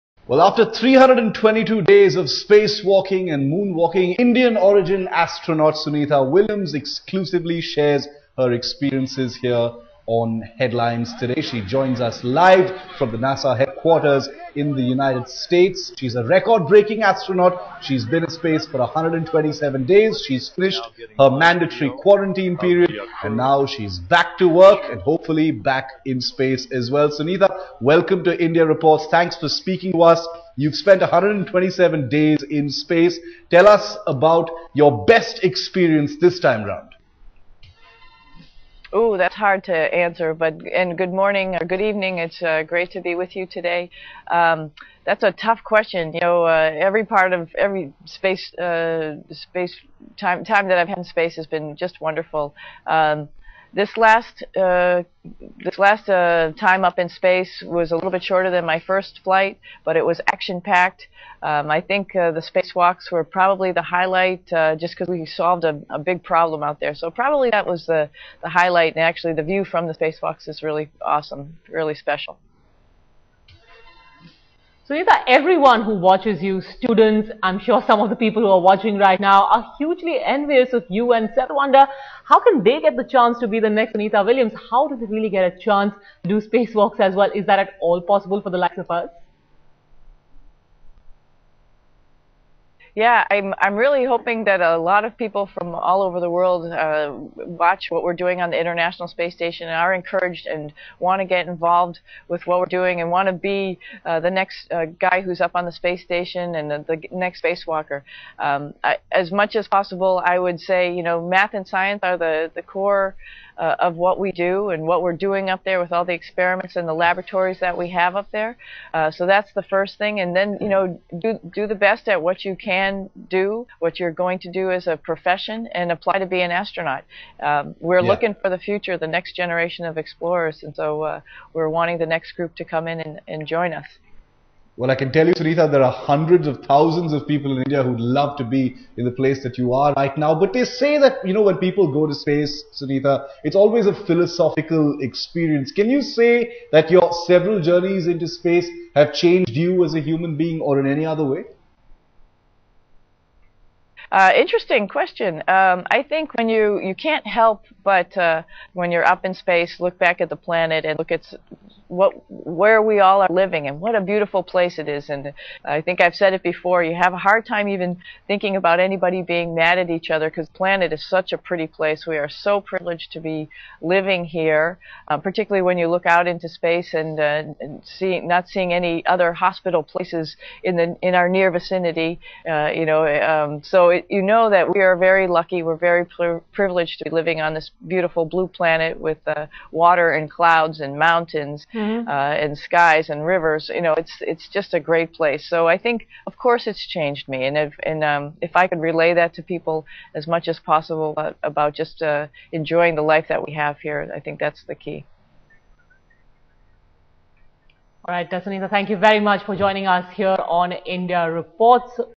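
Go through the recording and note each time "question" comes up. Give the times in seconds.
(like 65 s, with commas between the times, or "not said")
45 s, 154 s.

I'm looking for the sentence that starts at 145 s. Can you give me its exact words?
Can you say that your several journeys into space have changed you as a human being or in any other way?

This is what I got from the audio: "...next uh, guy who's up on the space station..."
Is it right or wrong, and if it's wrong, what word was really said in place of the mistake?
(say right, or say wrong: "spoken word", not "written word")
right.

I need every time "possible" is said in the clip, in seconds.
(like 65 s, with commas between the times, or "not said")
88 s, 109 s, 200 s.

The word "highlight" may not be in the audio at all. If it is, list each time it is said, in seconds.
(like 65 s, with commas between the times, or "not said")
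63 s, 68 s.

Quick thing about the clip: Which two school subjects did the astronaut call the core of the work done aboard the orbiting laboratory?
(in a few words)
Math and science.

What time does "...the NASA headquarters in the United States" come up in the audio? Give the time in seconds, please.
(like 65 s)
13 s.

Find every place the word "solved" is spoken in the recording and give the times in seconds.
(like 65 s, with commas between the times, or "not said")
65 s.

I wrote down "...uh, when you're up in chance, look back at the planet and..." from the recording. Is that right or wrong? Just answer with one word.
wrong.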